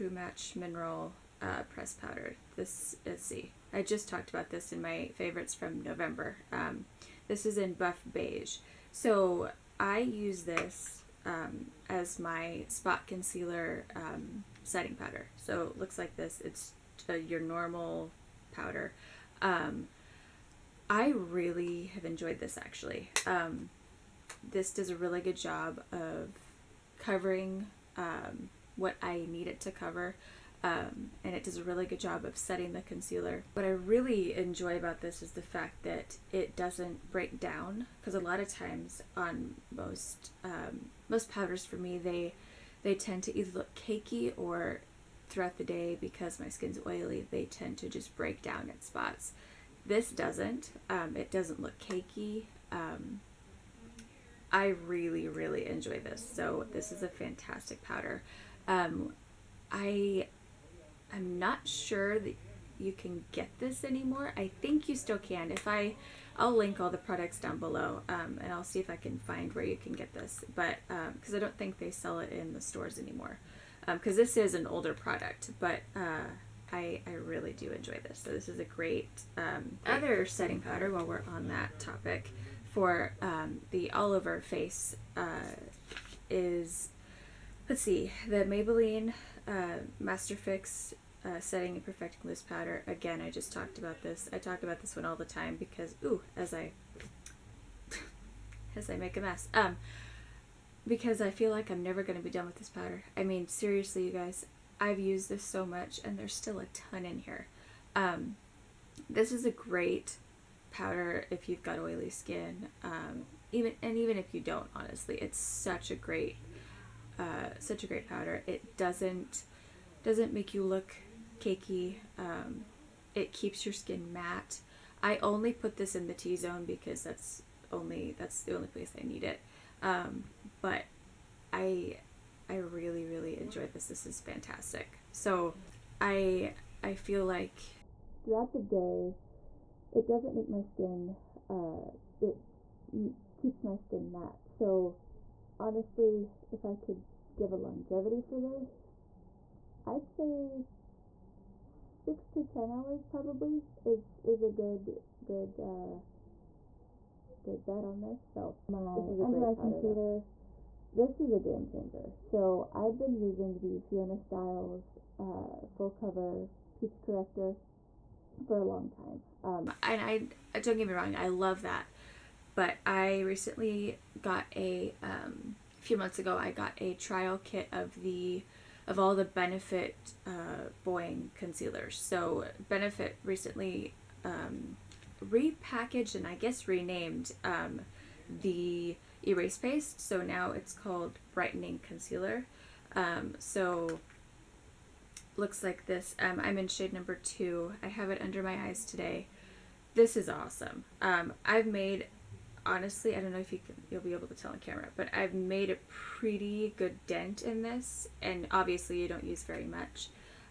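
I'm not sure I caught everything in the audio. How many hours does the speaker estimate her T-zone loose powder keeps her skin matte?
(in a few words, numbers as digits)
6 to 10 hours.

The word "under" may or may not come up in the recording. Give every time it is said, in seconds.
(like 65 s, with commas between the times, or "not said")
159 s, 198 s.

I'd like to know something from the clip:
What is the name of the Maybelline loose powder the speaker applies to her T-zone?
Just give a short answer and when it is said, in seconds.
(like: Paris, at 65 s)
Master Fix, at 89 s.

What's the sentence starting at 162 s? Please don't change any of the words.
So I've been using the Fiona Stiles uh, full cover peach corrector for a long time.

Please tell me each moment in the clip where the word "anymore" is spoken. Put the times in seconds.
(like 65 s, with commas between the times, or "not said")
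63 s, 72 s.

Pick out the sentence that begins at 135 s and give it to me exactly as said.
So I I feel like throughout the day, it doesn't make my skin.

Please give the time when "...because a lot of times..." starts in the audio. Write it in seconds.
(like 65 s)
37 s.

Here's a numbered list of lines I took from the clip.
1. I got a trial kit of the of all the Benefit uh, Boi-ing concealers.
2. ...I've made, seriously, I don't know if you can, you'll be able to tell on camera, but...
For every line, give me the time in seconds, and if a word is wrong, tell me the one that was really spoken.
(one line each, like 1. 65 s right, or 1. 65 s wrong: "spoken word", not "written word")
1. 176 s right
2. 201 s wrong: "honestly", not "seriously".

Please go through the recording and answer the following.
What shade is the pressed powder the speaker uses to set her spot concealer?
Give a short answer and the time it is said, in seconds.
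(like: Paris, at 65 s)
Buff beige, at 7 s.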